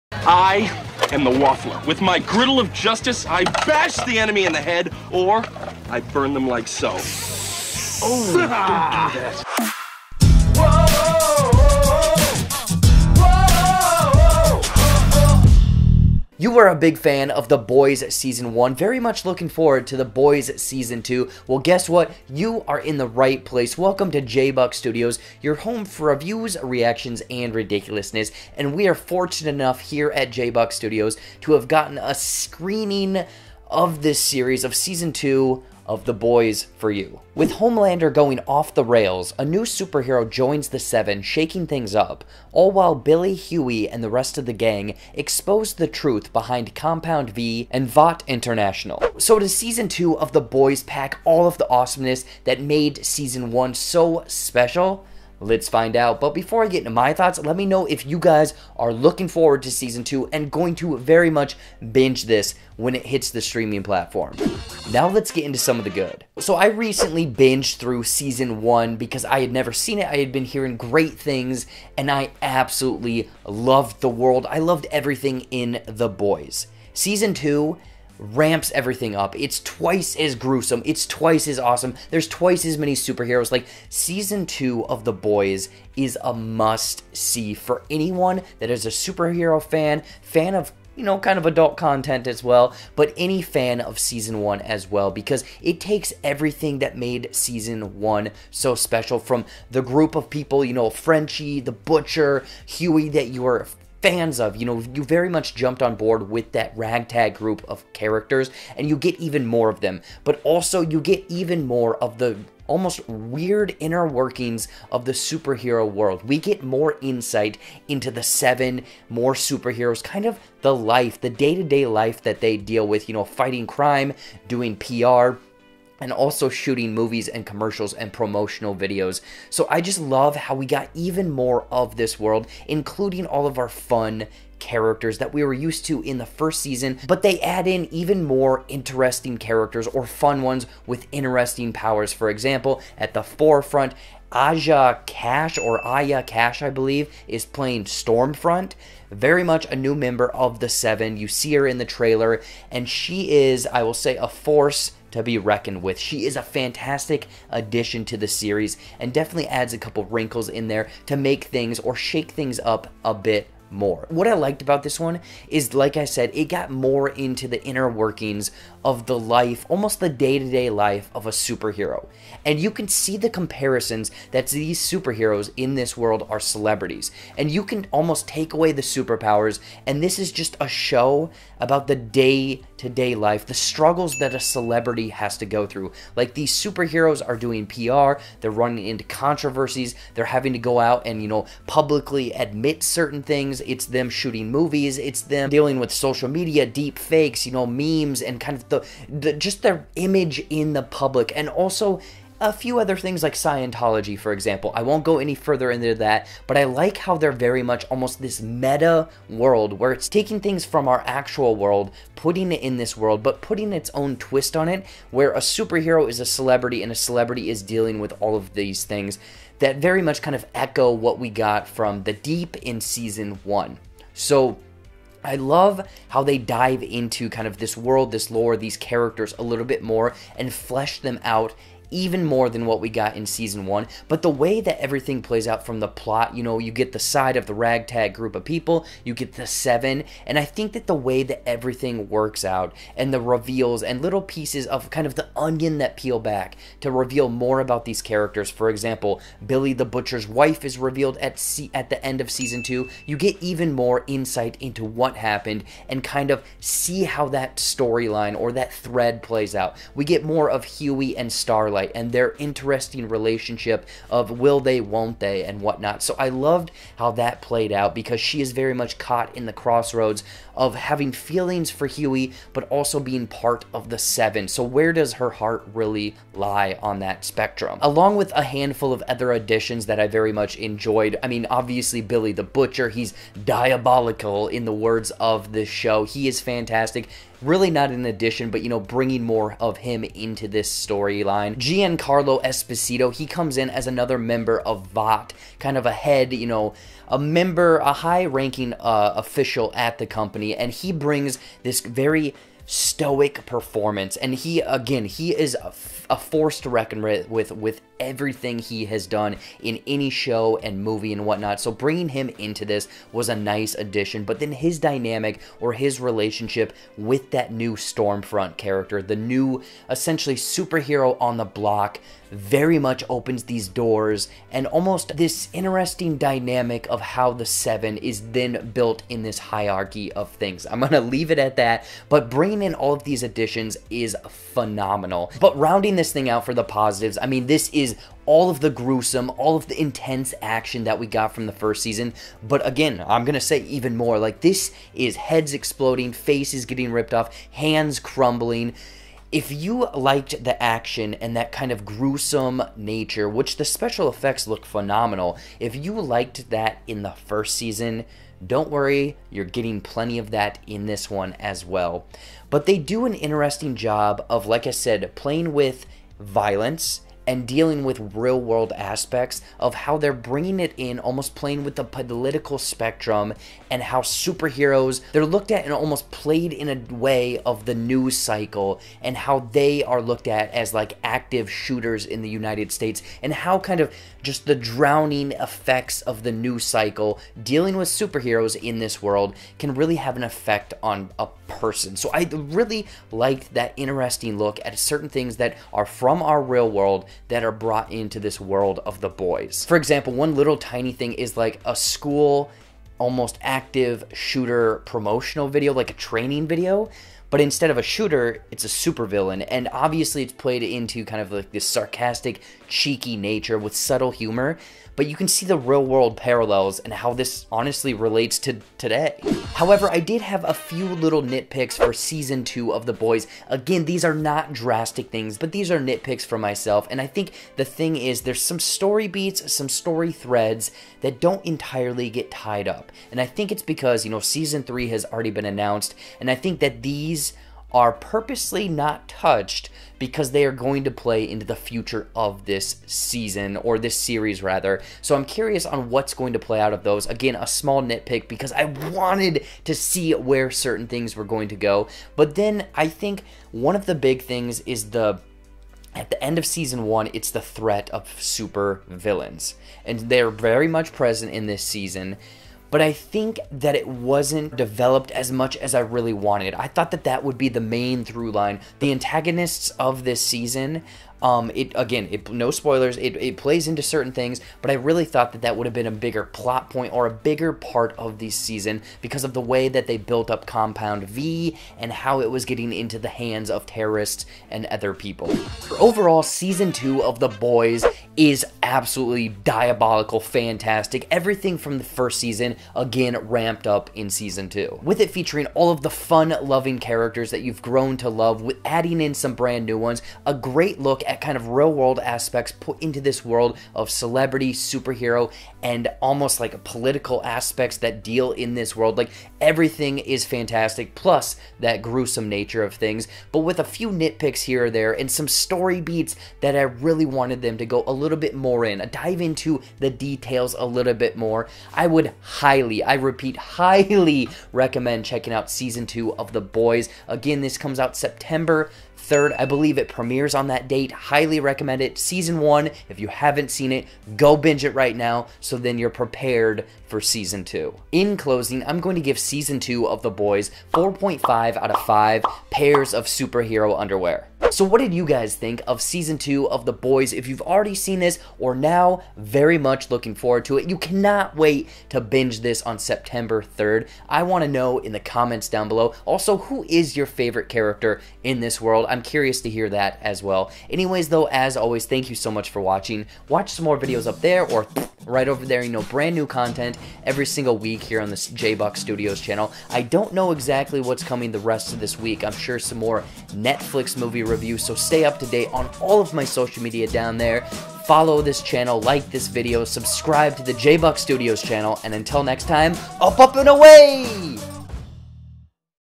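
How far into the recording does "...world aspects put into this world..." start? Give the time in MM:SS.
08:21.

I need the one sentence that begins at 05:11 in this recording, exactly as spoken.
So bringing him into this was a nice addition.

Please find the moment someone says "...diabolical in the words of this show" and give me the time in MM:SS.
04:43.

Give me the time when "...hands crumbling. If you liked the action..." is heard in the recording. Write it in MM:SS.
05:47.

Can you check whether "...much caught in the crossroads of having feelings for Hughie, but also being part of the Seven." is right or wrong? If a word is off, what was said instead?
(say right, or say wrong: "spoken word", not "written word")
right.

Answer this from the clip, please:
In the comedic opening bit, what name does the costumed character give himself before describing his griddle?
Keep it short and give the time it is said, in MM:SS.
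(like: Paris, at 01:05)
The Waffler, at 00:01.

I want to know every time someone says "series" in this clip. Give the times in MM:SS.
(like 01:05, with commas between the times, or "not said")
00:34, 02:38, 07:23.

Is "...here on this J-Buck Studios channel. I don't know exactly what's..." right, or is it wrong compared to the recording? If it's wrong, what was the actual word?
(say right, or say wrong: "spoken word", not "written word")
right.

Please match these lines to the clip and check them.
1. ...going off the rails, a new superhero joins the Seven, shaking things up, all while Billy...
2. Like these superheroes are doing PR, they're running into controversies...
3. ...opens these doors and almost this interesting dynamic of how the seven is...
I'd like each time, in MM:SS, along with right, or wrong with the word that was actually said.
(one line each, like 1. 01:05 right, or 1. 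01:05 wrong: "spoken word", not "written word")
1. 00:38 right
2. 03:06 right
3. 05:23 right.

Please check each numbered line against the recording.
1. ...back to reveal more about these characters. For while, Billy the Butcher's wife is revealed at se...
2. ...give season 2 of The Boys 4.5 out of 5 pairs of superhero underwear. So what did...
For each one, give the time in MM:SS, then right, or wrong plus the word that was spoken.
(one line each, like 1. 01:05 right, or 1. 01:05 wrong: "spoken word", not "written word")
1. 04:06 wrong: "example", not "while"
2. 08:59 right.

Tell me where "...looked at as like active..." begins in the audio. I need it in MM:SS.
06:20.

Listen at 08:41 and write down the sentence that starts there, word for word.
I would highly, I repeat, highly recommend checking out season two of The Boys.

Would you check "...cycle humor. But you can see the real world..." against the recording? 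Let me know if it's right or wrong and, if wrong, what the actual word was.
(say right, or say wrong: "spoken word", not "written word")
wrong: "subtle", not "cycle".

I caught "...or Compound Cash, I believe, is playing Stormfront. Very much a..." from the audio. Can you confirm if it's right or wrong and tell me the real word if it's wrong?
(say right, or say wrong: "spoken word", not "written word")
wrong: "Aya", not "Compound".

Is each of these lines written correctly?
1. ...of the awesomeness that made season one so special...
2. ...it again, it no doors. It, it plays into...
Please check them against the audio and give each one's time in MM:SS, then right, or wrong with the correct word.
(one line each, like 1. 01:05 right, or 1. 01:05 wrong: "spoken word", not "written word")
1. 00:51 right
2. 07:51 wrong: "spoilers", not "doors".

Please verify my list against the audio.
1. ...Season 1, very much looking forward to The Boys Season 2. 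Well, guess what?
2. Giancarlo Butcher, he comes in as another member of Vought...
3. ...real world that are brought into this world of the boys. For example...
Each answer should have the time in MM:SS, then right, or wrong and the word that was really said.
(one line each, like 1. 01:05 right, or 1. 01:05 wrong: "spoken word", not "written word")
1. 00:18 right
2. 04:51 wrong: "Esposito", not "Butcher"
3. 06:36 right.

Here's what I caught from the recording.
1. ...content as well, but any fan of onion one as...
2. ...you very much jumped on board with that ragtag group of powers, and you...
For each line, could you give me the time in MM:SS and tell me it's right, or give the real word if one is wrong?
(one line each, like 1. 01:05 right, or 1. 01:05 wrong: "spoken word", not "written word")
1. 01:31 wrong: "season", not "onion"
2. 01:44 wrong: "characters", not "powers".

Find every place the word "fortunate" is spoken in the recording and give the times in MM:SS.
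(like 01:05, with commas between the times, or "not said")
00:28.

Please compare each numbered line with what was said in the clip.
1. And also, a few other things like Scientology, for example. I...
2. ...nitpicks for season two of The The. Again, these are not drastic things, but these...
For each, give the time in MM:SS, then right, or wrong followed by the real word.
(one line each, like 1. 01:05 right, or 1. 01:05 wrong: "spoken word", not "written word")
1. 03:21 right
2. 07:01 wrong: "Boys", not "The".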